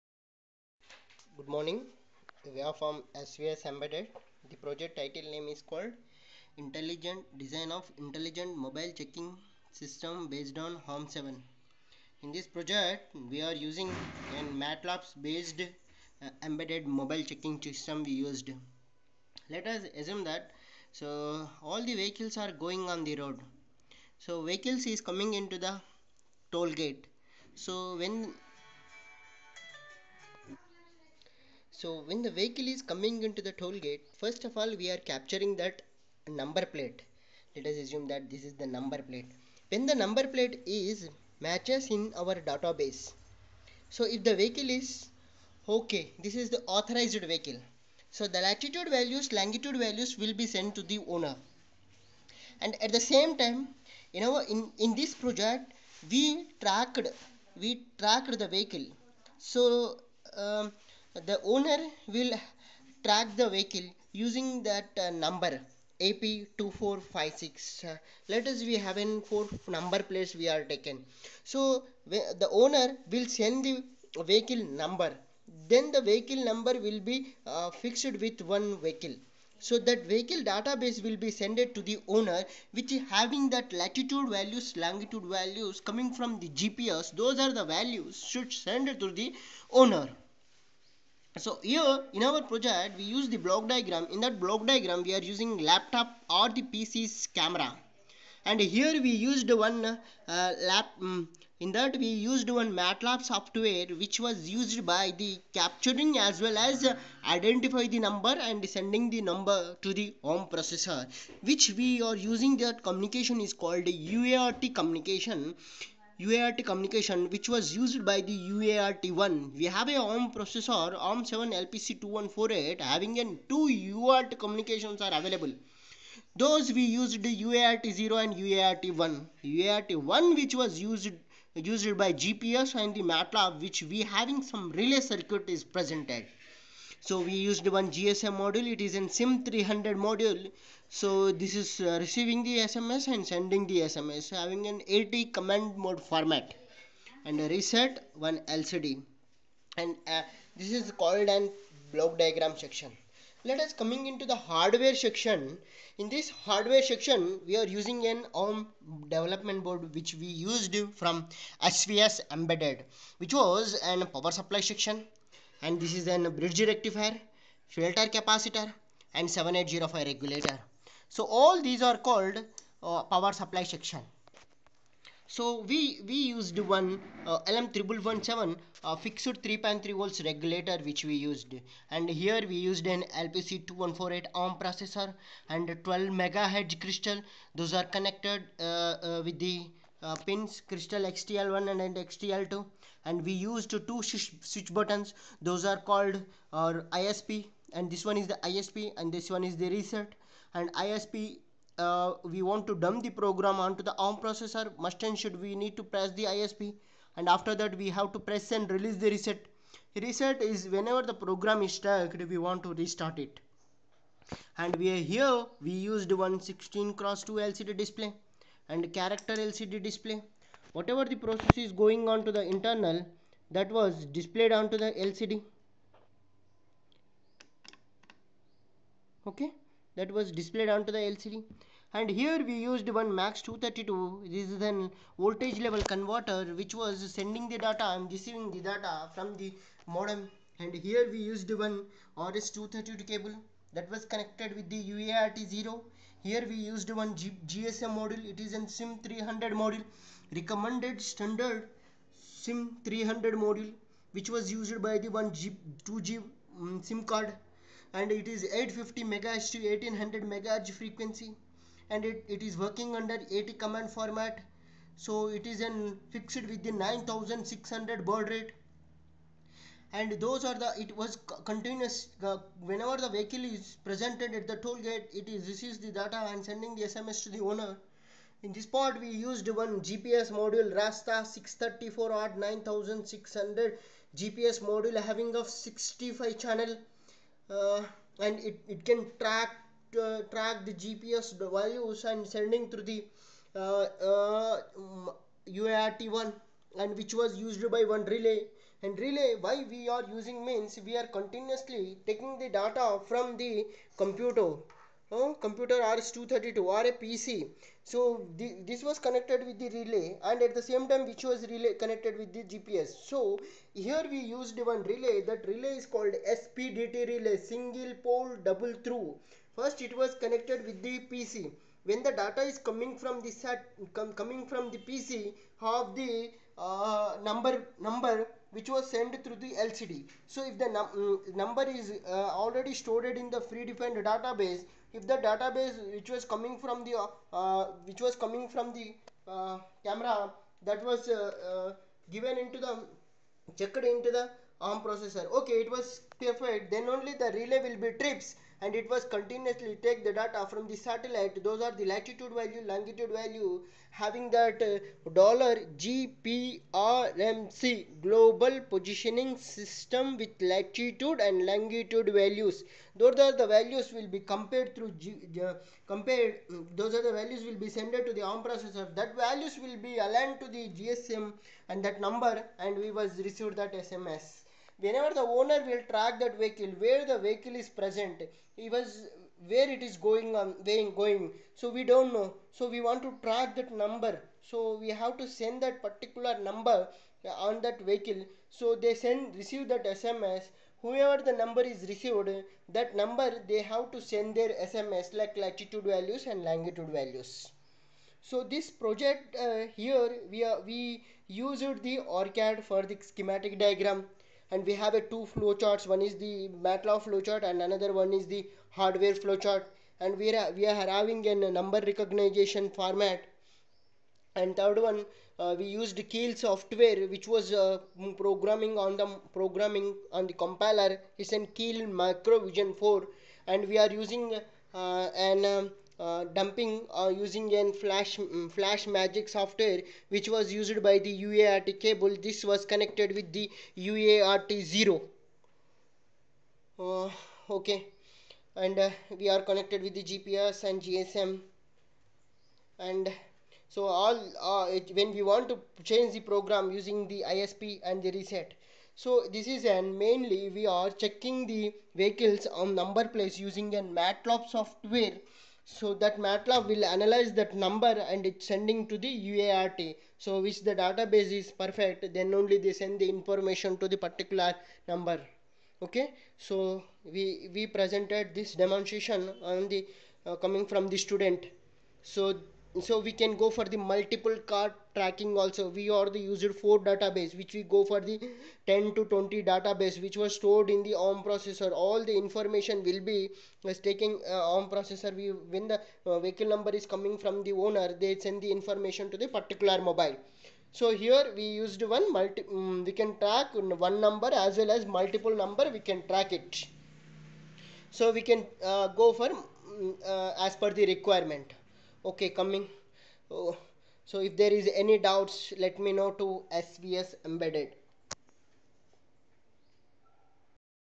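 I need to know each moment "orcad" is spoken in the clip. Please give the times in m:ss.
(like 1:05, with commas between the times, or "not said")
6:42.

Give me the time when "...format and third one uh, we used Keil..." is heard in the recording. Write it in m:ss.
6:52.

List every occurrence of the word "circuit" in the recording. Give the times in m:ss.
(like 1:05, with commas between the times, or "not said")
2:14.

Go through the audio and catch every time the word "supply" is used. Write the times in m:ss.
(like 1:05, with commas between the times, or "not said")
2:44, 2:53.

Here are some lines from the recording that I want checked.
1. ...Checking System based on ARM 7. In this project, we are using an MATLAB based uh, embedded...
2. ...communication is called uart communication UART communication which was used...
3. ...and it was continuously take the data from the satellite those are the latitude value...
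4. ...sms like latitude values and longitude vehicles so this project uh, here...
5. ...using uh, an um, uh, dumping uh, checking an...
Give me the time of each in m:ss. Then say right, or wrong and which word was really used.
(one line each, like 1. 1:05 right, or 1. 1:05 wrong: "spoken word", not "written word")
1. 0:08 right
2. 1:52 right
3. 5:48 right
4. 6:34 wrong: "values", not "vehicles"
5. 7:03 wrong: "using", not "checking".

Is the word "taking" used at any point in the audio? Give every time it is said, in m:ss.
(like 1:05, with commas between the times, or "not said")
5:02, 8:03.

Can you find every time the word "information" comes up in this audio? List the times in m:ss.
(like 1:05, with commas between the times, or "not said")
7:43, 8:02, 8:08.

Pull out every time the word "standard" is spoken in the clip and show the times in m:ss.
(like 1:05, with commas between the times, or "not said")
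4:11.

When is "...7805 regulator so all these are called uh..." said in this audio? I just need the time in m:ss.
2:49.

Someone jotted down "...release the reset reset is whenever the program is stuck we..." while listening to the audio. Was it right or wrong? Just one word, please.
right.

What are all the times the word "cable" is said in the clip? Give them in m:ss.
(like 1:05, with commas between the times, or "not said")
4:03, 7:11.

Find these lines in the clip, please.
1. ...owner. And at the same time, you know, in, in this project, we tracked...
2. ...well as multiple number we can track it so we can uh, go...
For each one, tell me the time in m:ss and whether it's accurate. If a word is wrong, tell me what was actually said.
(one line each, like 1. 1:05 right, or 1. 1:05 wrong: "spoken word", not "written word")
1. 0:51 right
2. 8:14 right.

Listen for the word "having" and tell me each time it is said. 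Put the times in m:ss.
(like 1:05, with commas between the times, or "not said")
1:23, 2:02, 2:14, 2:24, 4:45, 5:53, 6:50.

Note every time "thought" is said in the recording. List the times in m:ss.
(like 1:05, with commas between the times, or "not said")
not said.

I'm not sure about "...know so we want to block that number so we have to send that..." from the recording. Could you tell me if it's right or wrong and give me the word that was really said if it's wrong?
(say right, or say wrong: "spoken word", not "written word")
wrong: "track", not "block".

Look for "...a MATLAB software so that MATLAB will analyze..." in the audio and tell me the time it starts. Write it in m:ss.
7:33.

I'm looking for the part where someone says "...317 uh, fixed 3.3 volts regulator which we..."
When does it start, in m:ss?
2:57.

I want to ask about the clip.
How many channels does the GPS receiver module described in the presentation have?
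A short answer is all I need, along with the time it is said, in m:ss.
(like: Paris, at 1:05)
65, at 4:45.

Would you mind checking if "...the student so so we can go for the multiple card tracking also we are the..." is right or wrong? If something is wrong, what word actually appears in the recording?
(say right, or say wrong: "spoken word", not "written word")
right.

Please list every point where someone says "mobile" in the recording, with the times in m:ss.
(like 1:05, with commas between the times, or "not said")
0:08, 0:16, 8:09.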